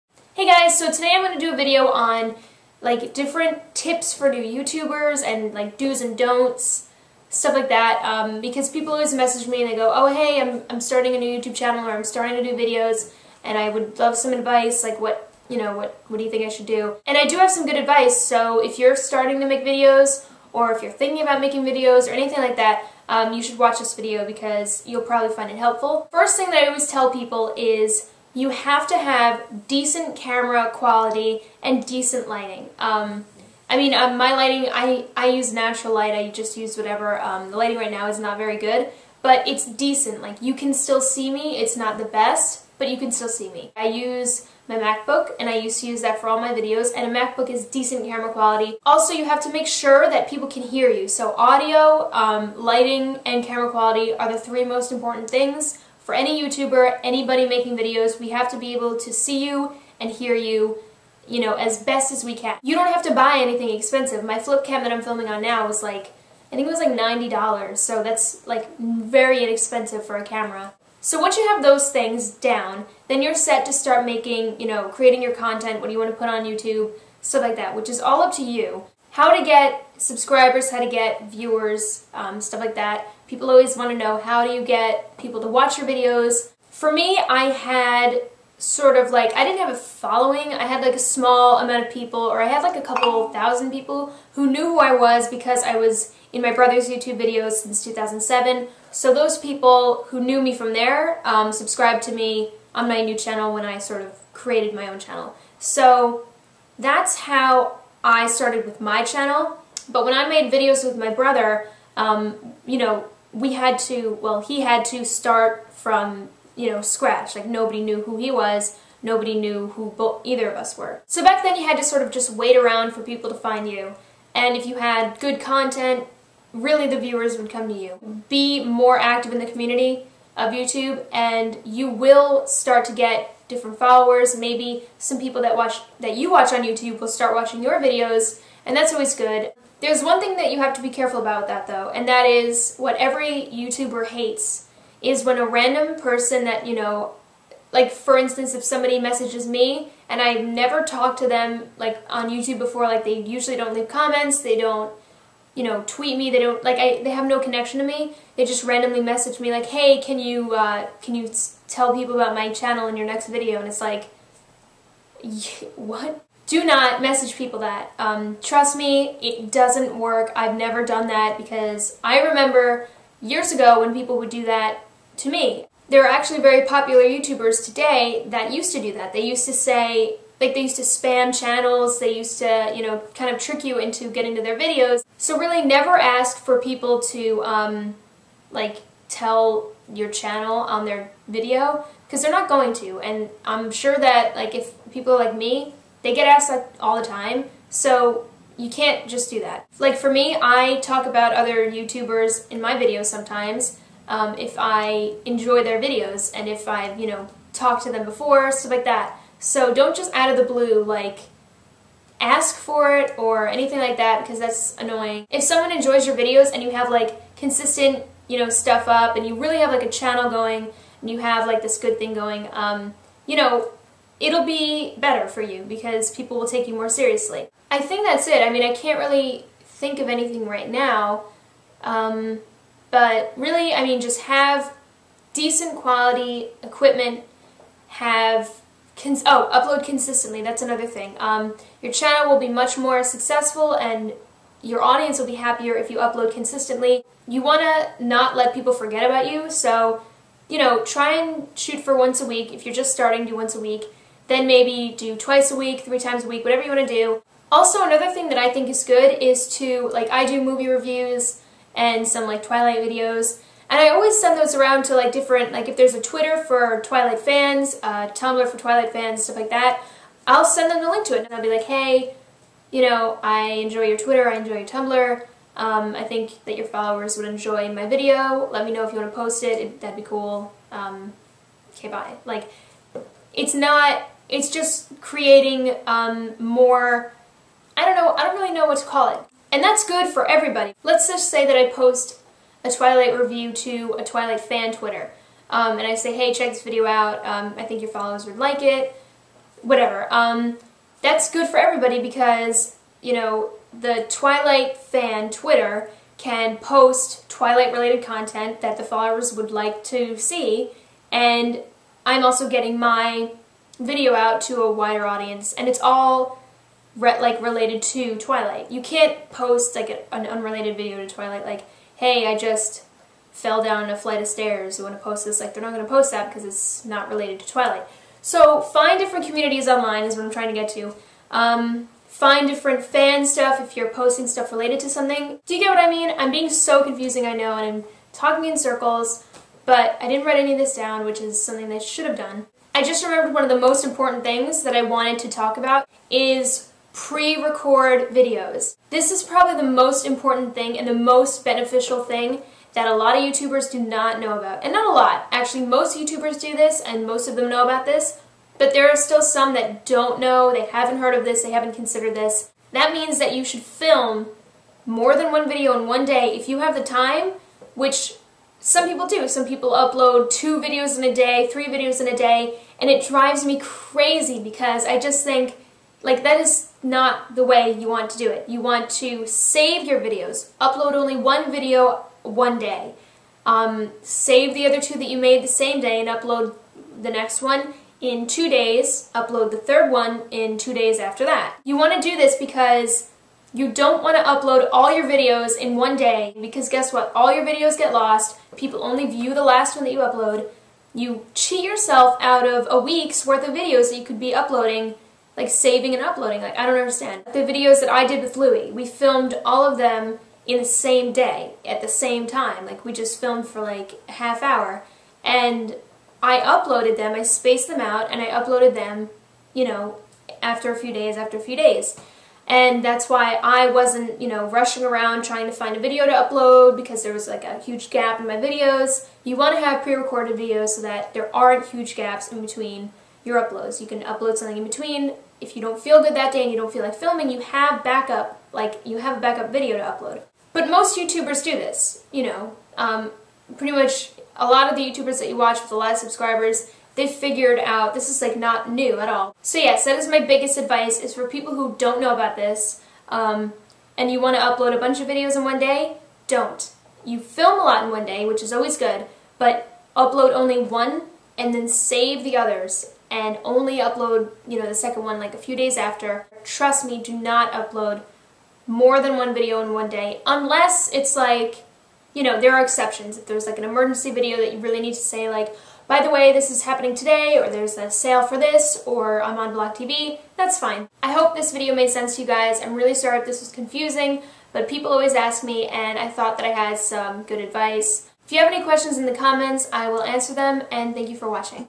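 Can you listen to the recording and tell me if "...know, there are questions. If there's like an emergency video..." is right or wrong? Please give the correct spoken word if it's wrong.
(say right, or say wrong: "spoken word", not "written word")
wrong: "exceptions", not "questions".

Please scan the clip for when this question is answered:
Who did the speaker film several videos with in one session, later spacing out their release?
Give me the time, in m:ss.
6:48.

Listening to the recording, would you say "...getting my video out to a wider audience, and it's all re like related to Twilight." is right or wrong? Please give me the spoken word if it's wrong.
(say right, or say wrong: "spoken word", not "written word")
right.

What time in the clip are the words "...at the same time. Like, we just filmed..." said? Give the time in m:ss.
6:51.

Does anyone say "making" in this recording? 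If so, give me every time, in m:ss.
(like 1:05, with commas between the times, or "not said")
0:21, 0:57, 1:14.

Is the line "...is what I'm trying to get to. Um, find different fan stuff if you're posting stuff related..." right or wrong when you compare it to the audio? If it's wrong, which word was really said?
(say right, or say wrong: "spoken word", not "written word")
right.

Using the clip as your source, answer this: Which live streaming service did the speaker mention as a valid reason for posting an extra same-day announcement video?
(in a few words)
BlogTV.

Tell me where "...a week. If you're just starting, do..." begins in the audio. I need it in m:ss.
4:12.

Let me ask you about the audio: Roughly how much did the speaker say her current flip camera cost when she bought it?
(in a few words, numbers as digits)
$90.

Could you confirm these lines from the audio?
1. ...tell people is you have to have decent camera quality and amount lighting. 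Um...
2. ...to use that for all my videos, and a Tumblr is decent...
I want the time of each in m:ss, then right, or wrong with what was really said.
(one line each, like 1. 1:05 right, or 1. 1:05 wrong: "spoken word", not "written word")
1. 0:26 wrong: "decent", not "amount"
2. 0:45 wrong: "MacBook", not "Tumblr".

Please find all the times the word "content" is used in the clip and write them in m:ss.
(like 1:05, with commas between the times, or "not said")
1:15, 2:05, 5:08.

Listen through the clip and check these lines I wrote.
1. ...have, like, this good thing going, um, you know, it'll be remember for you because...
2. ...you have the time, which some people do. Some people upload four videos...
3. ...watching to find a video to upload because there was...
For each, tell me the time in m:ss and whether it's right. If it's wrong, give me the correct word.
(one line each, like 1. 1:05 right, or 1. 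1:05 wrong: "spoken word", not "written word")
1. 3:41 wrong: "better", not "remember"
2. 6:06 wrong: "two", not "four"
3. 7:05 wrong: "trying", not "watching".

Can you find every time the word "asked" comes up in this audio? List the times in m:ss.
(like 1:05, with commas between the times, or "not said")
3:16.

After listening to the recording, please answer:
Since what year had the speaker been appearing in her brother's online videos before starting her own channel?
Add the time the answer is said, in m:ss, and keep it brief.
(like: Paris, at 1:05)
2007, at 1:37.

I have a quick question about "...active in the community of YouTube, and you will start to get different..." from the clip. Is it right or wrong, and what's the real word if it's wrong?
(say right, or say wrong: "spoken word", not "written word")
right.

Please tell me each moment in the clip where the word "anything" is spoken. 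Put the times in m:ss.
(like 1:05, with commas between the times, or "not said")
0:22, 1:03, 3:33, 3:50.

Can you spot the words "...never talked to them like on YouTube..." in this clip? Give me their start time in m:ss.
2:30.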